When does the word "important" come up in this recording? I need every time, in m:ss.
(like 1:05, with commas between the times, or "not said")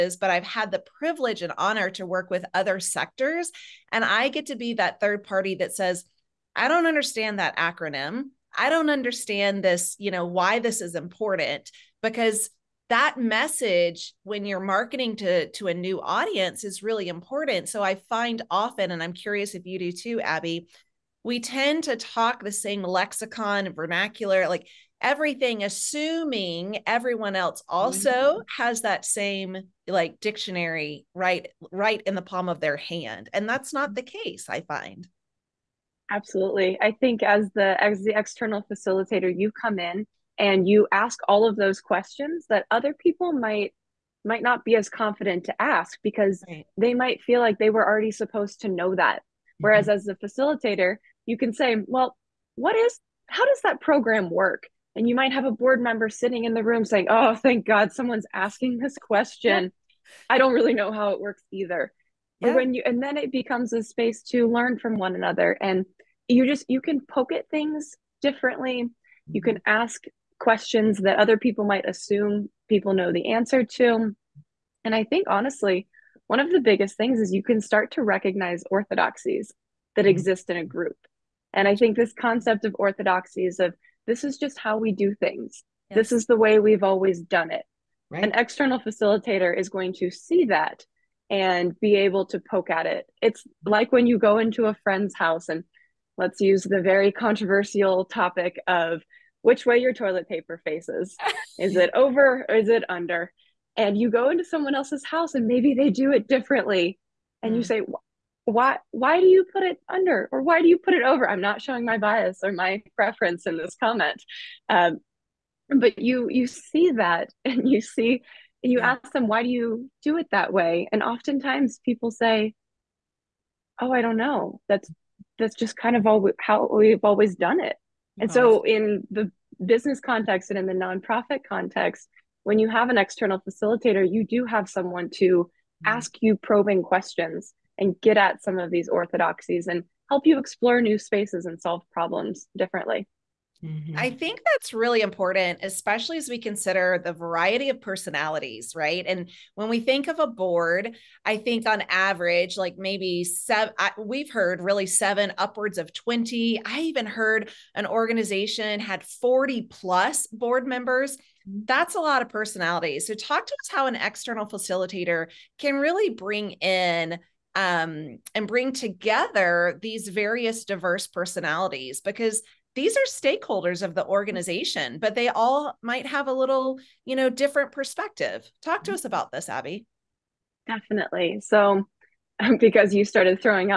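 0:10, 0:17, 2:25.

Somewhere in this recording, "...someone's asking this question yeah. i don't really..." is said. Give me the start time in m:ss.
0:57.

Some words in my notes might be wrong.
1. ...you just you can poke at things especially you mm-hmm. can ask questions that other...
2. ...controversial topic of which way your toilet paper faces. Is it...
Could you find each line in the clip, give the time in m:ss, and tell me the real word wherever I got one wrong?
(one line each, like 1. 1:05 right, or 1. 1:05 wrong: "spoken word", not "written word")
1. 1:06 wrong: "differently", not "especially"
2. 1:37 right.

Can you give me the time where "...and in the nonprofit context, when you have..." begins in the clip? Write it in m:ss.
2:10.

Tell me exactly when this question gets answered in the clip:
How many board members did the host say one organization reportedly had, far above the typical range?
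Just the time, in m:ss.
2:39.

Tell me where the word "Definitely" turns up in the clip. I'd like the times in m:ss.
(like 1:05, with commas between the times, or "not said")
3:00.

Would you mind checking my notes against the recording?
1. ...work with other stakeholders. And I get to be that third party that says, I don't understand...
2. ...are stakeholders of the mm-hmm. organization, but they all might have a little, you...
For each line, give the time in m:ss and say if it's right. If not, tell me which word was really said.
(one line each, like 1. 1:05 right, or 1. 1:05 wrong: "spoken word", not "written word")
1. 0:02 wrong: "sectors", not "stakeholders"
2. 2:52 right.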